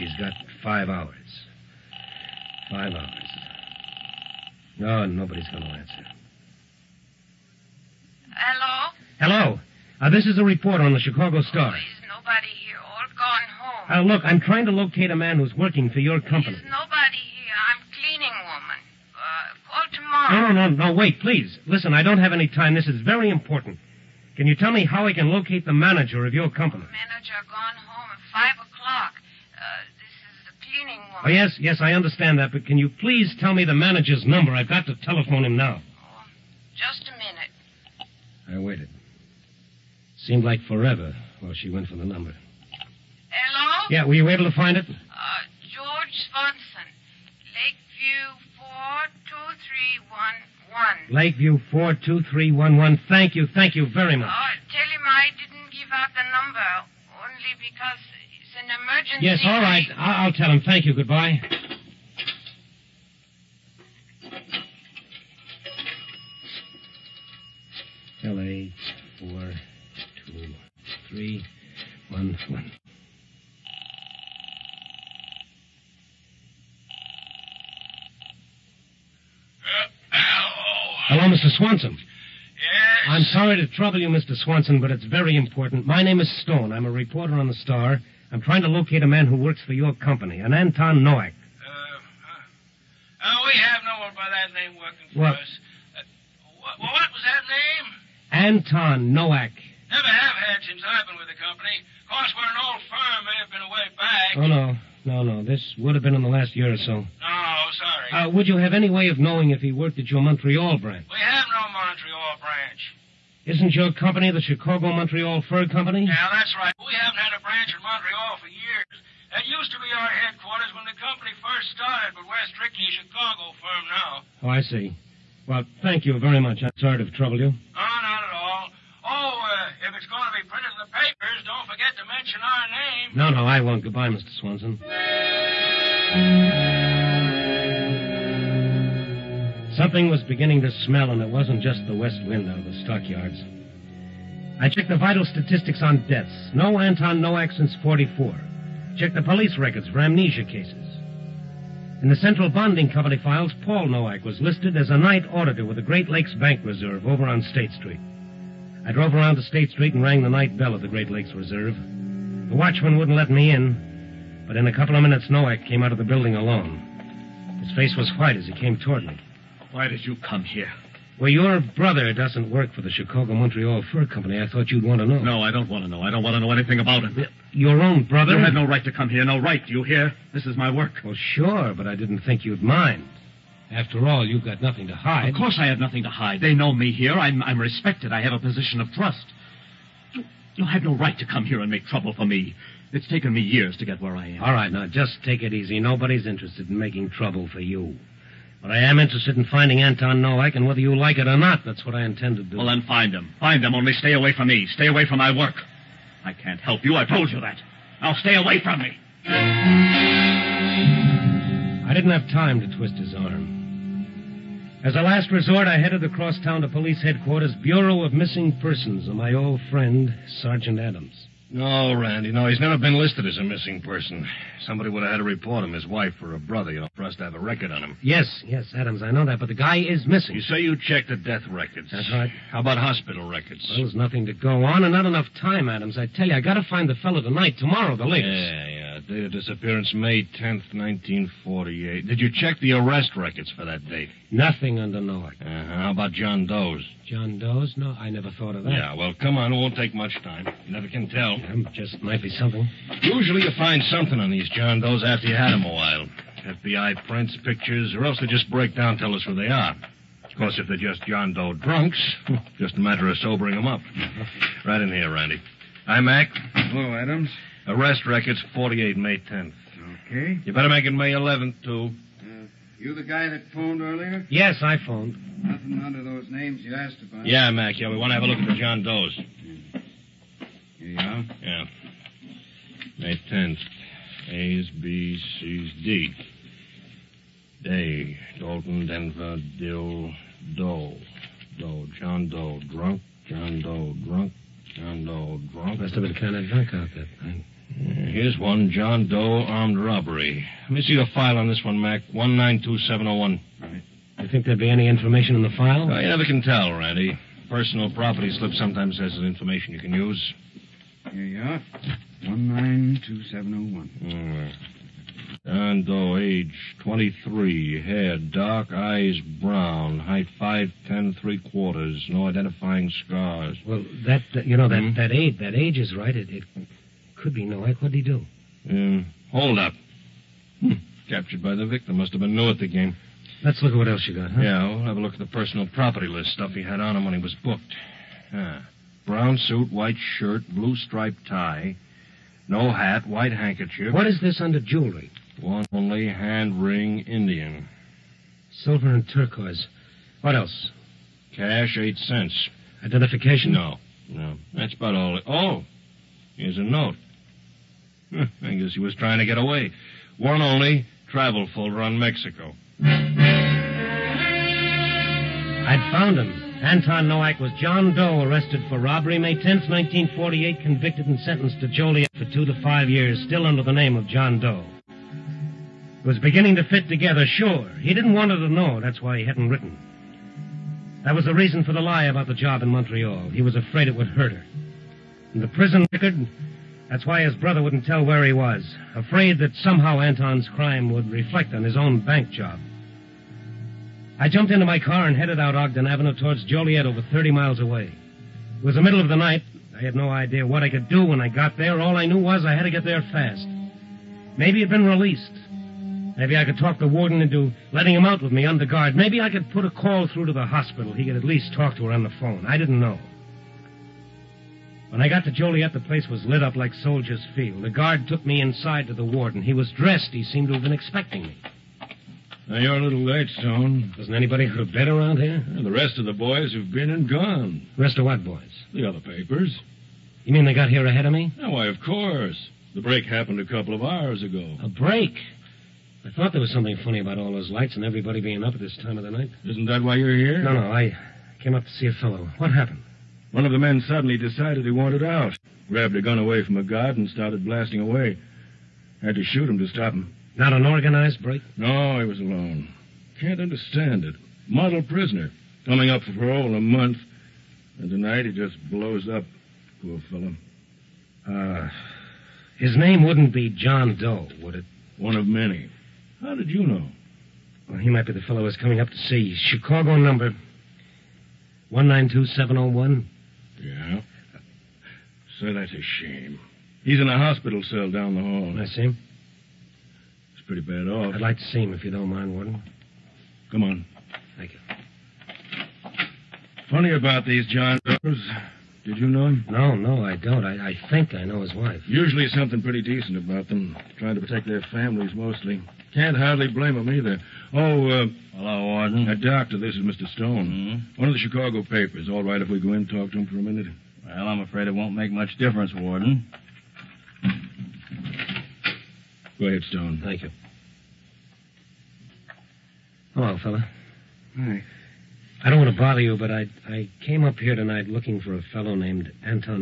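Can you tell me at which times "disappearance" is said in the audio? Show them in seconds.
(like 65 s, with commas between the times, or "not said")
239 s.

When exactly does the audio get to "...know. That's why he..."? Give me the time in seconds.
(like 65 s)
378 s.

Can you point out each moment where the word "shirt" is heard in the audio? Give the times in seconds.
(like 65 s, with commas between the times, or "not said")
339 s.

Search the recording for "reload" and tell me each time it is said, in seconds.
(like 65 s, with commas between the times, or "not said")
not said.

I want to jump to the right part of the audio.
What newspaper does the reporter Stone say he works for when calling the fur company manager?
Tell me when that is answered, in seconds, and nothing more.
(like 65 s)
87 s.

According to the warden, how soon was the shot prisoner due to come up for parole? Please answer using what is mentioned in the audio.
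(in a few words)
a month.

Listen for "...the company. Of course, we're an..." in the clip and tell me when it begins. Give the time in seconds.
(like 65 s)
101 s.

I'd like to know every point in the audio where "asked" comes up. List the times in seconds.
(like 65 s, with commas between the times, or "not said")
276 s.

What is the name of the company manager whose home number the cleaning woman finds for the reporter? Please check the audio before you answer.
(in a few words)
George Swanson.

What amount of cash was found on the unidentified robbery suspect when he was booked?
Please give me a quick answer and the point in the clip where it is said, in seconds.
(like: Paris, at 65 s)
8 cents, at 351 s.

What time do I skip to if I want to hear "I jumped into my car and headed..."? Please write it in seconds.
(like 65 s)
394 s.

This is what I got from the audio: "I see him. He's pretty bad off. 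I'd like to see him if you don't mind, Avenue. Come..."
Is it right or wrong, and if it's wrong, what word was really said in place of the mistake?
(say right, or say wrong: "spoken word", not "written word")
wrong: "Warden", not "Avenue".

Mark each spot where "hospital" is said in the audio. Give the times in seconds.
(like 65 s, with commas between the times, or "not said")
232 s, 410 s, 477 s.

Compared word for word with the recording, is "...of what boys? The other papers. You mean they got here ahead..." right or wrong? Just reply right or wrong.
right.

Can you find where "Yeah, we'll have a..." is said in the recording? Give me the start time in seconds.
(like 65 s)
334 s.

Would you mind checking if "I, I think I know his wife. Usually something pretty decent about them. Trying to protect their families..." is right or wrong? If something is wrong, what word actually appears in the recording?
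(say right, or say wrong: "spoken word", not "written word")
right.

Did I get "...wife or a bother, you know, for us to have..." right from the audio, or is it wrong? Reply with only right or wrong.
wrong.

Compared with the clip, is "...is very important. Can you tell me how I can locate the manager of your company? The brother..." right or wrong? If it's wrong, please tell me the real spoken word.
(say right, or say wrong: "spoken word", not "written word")
wrong: "manager", not "brother".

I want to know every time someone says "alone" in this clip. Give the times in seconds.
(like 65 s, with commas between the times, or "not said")
166 s, 452 s.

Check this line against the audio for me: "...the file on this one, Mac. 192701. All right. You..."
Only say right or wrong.
right.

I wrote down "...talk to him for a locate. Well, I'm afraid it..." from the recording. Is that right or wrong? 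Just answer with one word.
wrong.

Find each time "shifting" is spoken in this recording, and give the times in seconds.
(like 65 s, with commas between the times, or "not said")
not said.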